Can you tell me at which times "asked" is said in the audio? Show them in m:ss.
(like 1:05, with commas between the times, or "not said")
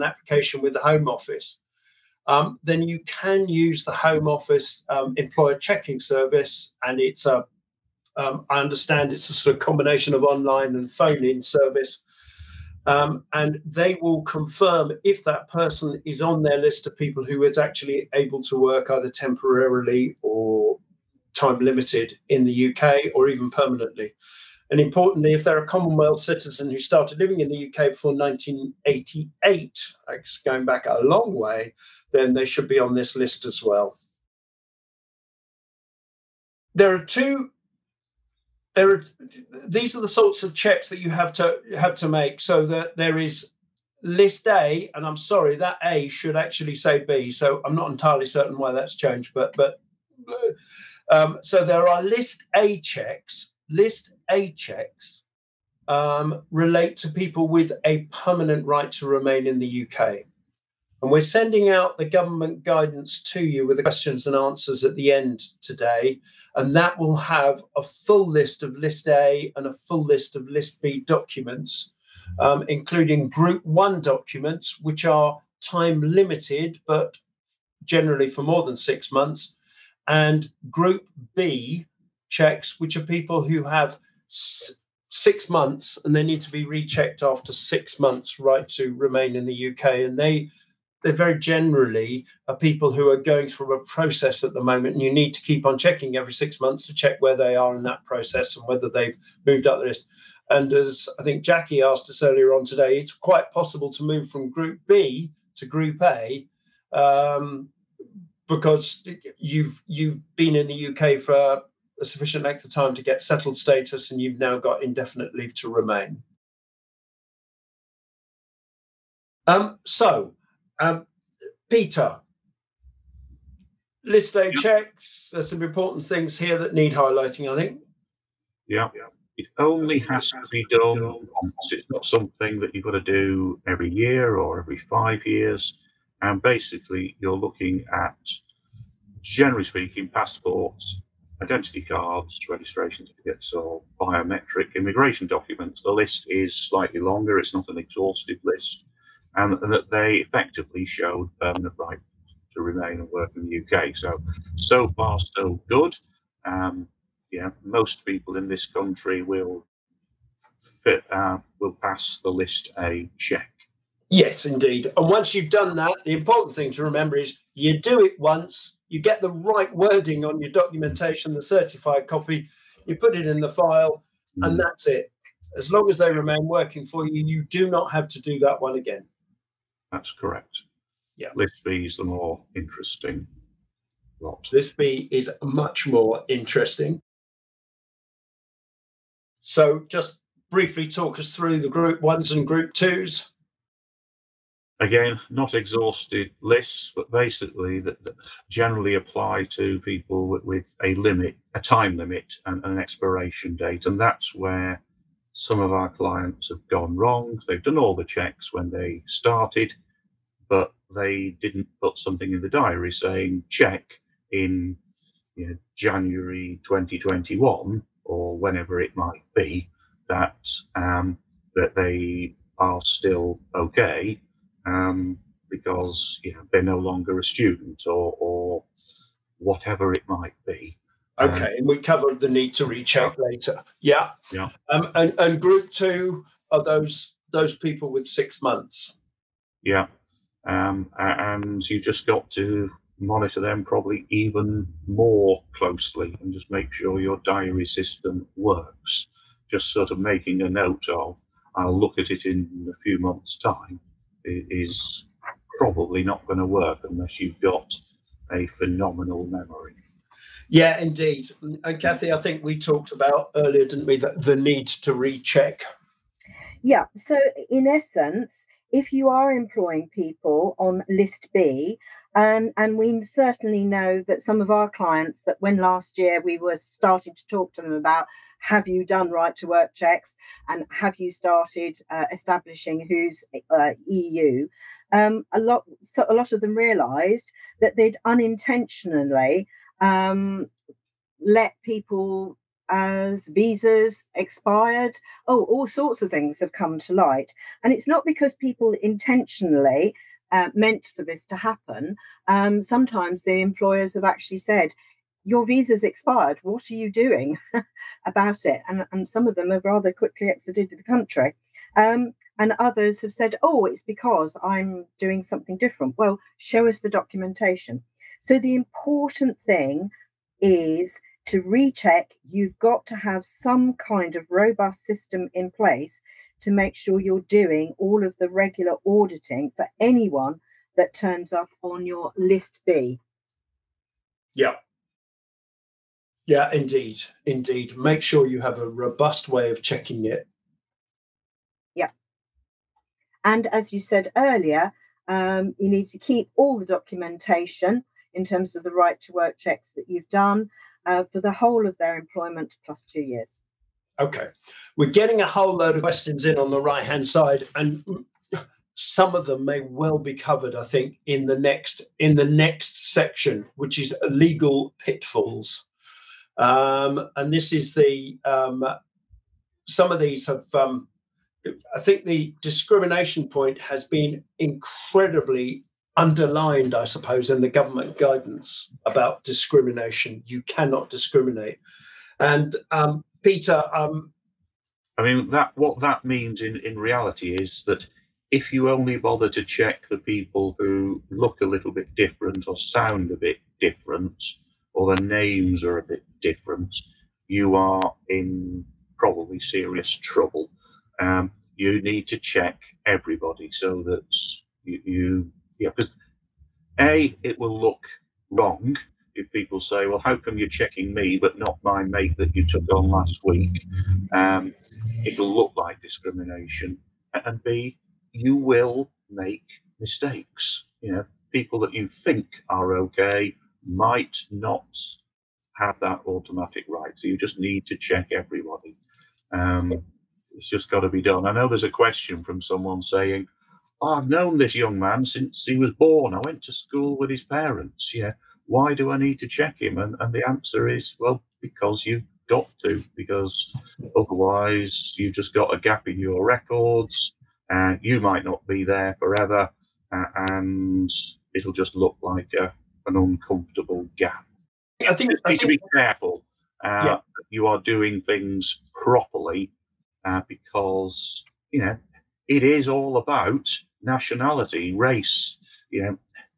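1:41.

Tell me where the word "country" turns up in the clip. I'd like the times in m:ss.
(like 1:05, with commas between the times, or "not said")
2:38, 5:10.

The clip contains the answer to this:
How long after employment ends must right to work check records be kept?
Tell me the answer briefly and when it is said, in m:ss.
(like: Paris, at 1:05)
2 years, at 5:52.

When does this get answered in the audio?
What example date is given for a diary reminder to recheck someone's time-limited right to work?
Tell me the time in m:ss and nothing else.
3:35.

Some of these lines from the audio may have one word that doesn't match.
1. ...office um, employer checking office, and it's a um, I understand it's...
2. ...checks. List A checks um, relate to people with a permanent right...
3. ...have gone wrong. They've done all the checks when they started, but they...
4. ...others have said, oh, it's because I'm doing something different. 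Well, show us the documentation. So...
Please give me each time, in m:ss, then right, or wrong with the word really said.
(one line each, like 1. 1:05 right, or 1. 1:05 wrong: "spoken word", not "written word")
1. 0:04 wrong: "service", not "office"
2. 0:52 right
3. 3:26 right
4. 5:12 right.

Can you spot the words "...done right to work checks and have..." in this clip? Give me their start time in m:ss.
4:38.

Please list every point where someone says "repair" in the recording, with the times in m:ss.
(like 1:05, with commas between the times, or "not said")
not said.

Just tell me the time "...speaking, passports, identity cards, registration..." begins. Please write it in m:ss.
2:19.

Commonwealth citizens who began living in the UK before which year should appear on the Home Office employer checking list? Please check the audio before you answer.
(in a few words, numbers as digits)
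1988.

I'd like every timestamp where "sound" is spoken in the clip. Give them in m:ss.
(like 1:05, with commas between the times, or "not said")
6:32.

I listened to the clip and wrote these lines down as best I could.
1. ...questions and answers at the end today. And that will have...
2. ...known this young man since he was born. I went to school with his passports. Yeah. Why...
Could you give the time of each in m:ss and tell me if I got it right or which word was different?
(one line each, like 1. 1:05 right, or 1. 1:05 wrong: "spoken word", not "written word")
1. 1:03 right
2. 7:14 wrong: "parents", not "passports".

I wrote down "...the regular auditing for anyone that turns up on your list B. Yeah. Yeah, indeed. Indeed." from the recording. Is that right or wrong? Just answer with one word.
right.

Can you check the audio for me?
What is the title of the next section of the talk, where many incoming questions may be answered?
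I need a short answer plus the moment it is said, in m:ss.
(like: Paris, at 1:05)
legal pitfalls, at 6:04.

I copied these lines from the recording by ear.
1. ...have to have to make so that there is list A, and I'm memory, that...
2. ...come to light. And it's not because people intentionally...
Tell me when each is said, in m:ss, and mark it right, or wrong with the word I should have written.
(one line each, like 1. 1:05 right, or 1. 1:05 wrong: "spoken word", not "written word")
1. 0:41 wrong: "sorry", not "memory"
2. 4:56 right.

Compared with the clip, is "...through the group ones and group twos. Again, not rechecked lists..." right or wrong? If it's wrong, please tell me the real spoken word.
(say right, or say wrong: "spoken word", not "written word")
wrong: "exhausted", not "rechecked".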